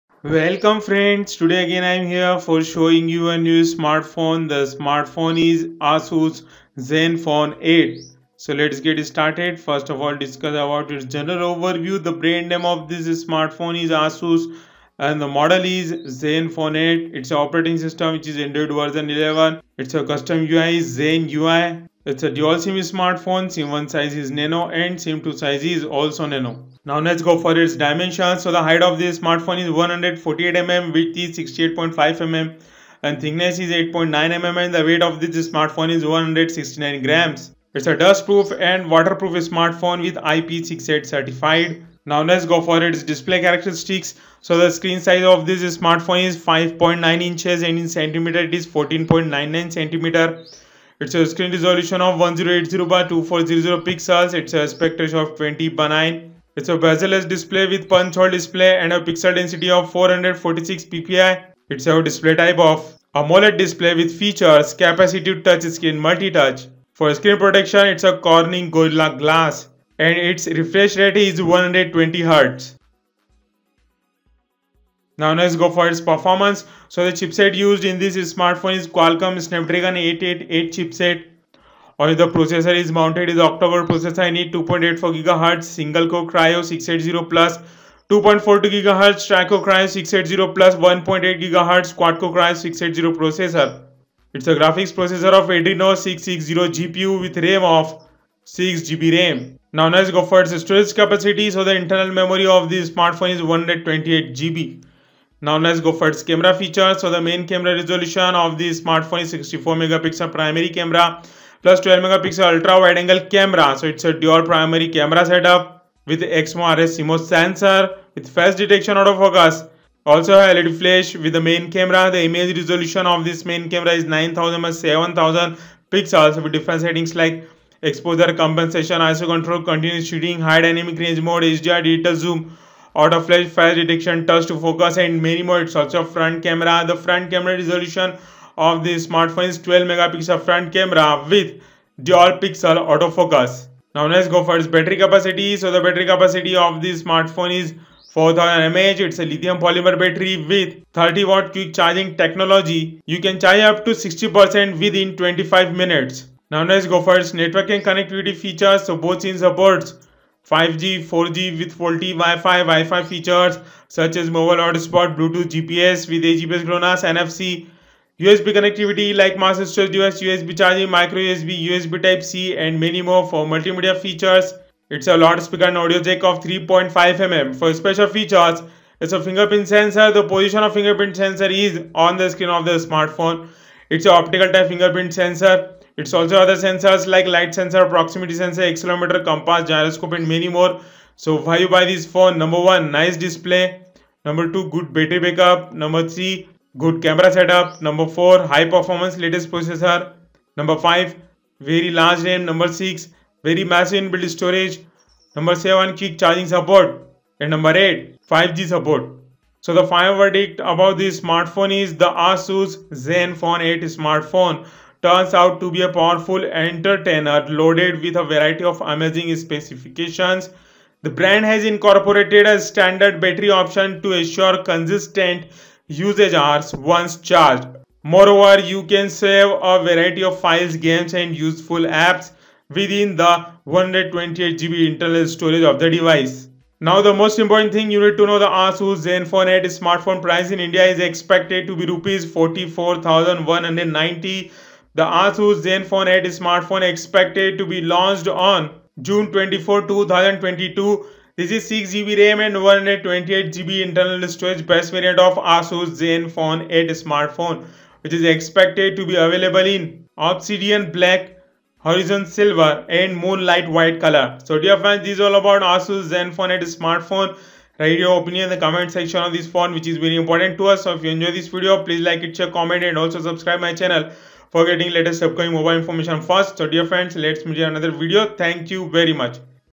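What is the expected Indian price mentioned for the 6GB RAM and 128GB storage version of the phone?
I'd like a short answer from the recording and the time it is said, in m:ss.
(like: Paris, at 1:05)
Rs 44,190, at 4:01.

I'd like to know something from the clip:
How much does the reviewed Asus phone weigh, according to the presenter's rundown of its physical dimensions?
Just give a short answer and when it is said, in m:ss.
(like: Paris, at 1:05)
169 grams, at 0:36.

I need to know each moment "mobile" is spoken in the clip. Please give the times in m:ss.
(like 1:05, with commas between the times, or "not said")
2:44, 4:35.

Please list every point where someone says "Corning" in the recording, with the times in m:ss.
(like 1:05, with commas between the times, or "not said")
1:08.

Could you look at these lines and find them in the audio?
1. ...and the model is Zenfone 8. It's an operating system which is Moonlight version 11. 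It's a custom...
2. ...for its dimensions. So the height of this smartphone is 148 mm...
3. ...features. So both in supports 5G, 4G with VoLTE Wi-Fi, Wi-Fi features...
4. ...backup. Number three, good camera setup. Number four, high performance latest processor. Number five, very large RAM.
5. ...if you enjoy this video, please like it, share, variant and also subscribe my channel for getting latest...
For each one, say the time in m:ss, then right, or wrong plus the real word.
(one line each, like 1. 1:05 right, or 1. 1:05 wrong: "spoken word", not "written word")
1. 0:15 wrong: "Android", not "Moonlight"
2. 0:27 right
3. 2:38 right
4. 3:15 right
5. 4:30 wrong: "comment", not "variant".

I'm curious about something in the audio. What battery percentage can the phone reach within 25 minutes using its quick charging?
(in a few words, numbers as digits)
60%.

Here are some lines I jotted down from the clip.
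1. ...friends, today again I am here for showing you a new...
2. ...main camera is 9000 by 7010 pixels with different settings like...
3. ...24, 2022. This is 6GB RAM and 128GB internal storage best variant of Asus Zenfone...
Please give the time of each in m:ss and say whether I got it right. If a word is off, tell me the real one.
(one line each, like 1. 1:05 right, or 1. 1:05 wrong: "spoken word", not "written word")
1. 0:00 right
2. 2:03 wrong: "7000", not "7010"
3. 4:09 right.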